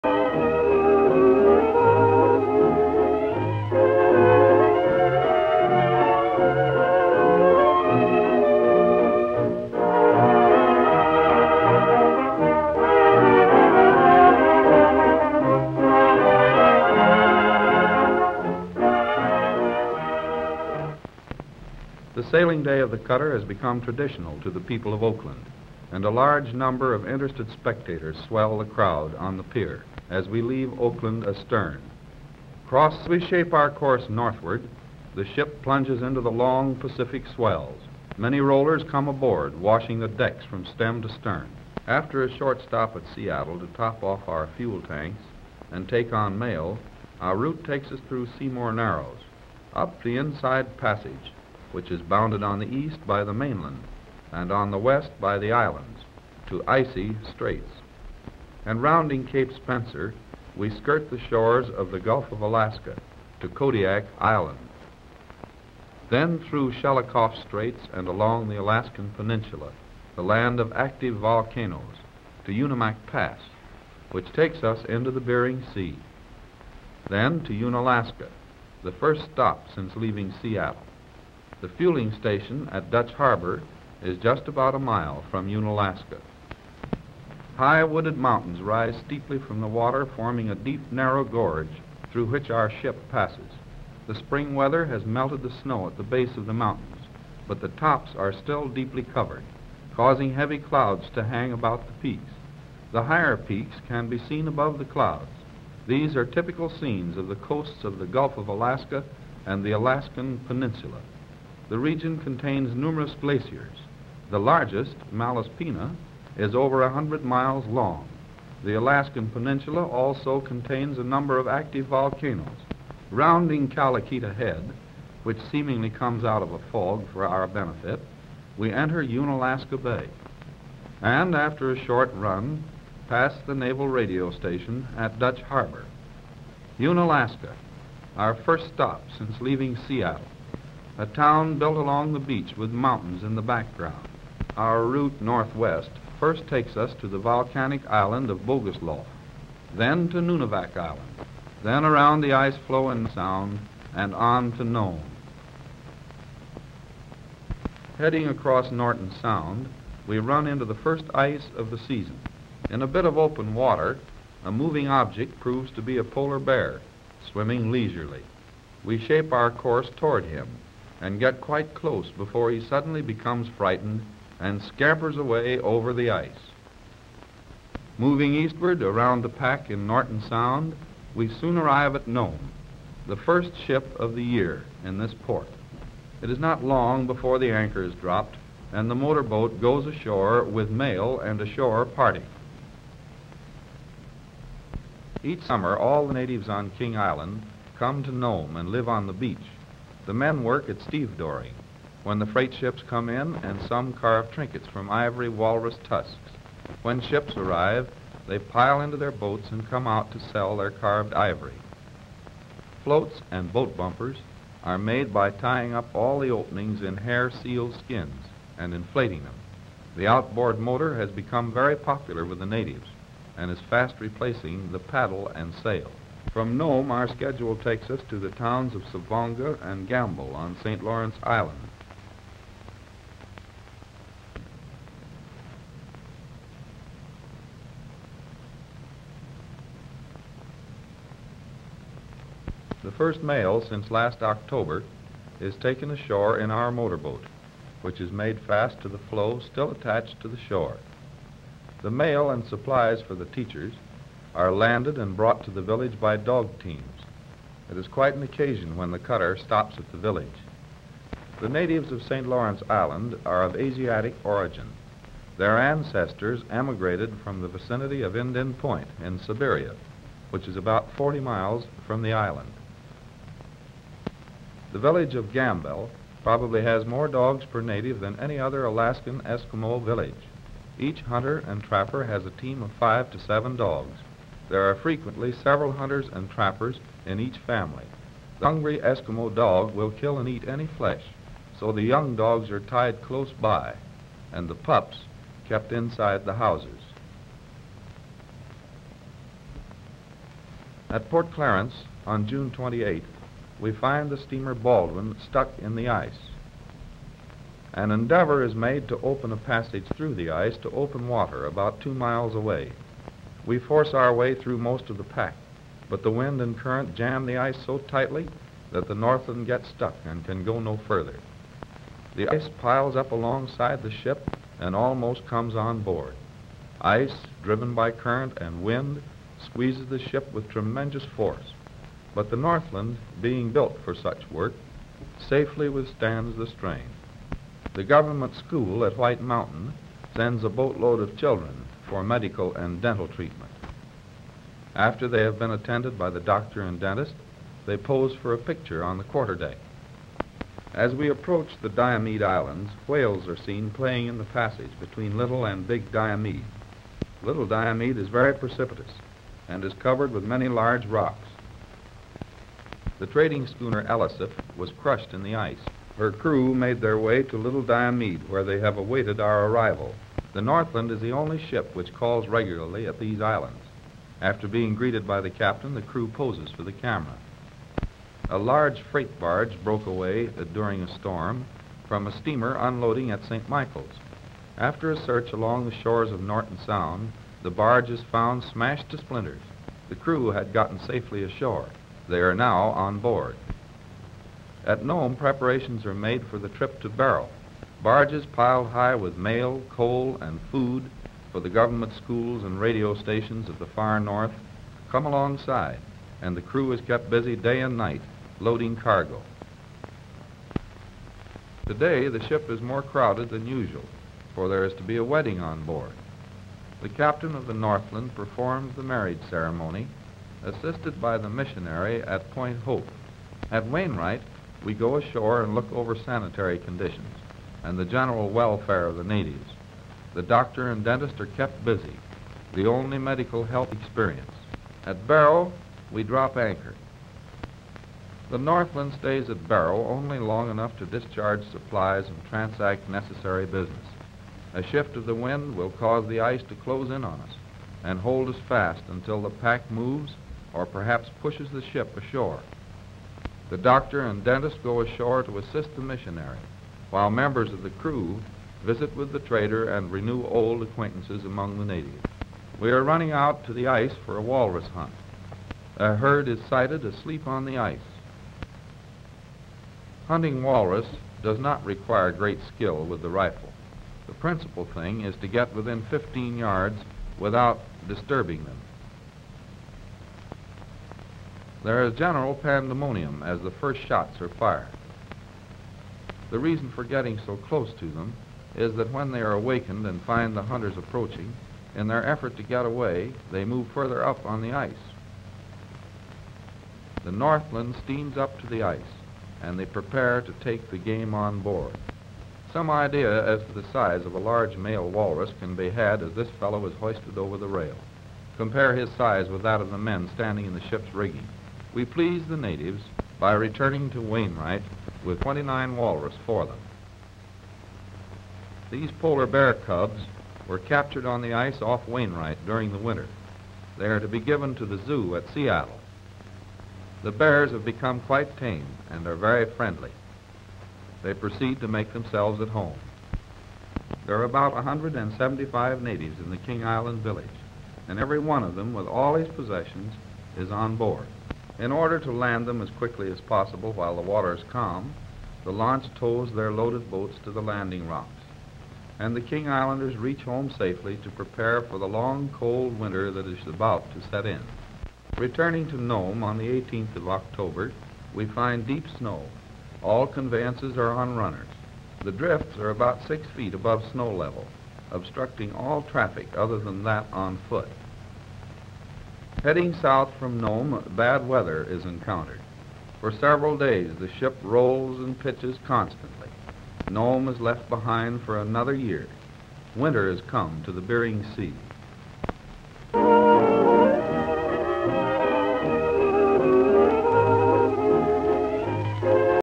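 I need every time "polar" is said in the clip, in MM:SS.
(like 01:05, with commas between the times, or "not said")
02:46, 08:38.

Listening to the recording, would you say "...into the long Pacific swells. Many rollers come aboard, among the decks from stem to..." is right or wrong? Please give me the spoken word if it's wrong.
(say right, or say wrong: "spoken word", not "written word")
wrong: "washing", not "among".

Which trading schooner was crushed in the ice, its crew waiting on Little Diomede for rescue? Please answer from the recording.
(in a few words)
Ellisif.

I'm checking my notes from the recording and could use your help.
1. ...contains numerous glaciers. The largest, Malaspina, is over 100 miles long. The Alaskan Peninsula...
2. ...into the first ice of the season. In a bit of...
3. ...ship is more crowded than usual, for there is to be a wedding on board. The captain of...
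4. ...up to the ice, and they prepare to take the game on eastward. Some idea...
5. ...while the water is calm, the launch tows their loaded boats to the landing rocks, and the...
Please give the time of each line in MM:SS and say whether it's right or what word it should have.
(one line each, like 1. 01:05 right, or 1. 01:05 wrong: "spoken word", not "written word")
1. 01:52 right
2. 02:40 right
3. 06:52 right
4. 08:18 wrong: "board", not "eastward"
5. 09:03 right.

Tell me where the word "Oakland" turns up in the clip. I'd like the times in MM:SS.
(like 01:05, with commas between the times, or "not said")
00:25, 00:30.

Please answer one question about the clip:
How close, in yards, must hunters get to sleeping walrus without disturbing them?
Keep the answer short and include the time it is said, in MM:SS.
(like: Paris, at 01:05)
15 yards, at 07:55.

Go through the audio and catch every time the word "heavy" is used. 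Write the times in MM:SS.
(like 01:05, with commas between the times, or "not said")
01:40.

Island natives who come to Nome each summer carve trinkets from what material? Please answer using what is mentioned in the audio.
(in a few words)
ivory walrus tusks.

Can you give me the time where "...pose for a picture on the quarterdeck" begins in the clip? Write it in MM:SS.
05:47.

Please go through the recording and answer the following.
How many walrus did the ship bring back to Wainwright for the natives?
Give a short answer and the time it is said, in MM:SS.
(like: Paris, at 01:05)
29, at 08:35.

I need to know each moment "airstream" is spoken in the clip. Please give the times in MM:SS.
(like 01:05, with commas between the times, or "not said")
not said.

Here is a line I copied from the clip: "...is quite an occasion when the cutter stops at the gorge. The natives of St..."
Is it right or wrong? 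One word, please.
wrong.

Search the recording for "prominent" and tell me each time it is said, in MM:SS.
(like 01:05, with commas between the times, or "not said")
not said.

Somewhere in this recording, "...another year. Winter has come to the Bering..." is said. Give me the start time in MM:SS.
09:38.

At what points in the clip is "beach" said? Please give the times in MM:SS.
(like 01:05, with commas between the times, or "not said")
02:22, 03:19.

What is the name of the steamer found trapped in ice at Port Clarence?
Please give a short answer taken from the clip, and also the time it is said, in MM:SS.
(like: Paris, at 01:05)
Baldwin, at 05:04.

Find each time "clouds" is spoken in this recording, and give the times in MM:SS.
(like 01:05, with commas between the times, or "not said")
01:40, 01:44.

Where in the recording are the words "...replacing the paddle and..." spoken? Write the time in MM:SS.
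03:43.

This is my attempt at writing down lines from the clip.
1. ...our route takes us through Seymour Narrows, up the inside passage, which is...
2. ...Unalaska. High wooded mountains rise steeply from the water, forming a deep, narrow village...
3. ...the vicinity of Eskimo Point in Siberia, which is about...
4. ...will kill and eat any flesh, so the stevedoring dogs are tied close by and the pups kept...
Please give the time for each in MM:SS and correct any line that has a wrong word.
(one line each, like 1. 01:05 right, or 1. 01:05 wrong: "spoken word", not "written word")
1. 00:47 right
2. 01:25 wrong: "gorge", not "village"
3. 04:27 wrong: "Indian", not "Eskimo"
4. 04:49 wrong: "young", not "stevedoring".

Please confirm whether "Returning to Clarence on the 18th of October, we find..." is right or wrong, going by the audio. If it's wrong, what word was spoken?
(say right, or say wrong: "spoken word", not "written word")
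wrong: "Nome", not "Clarence".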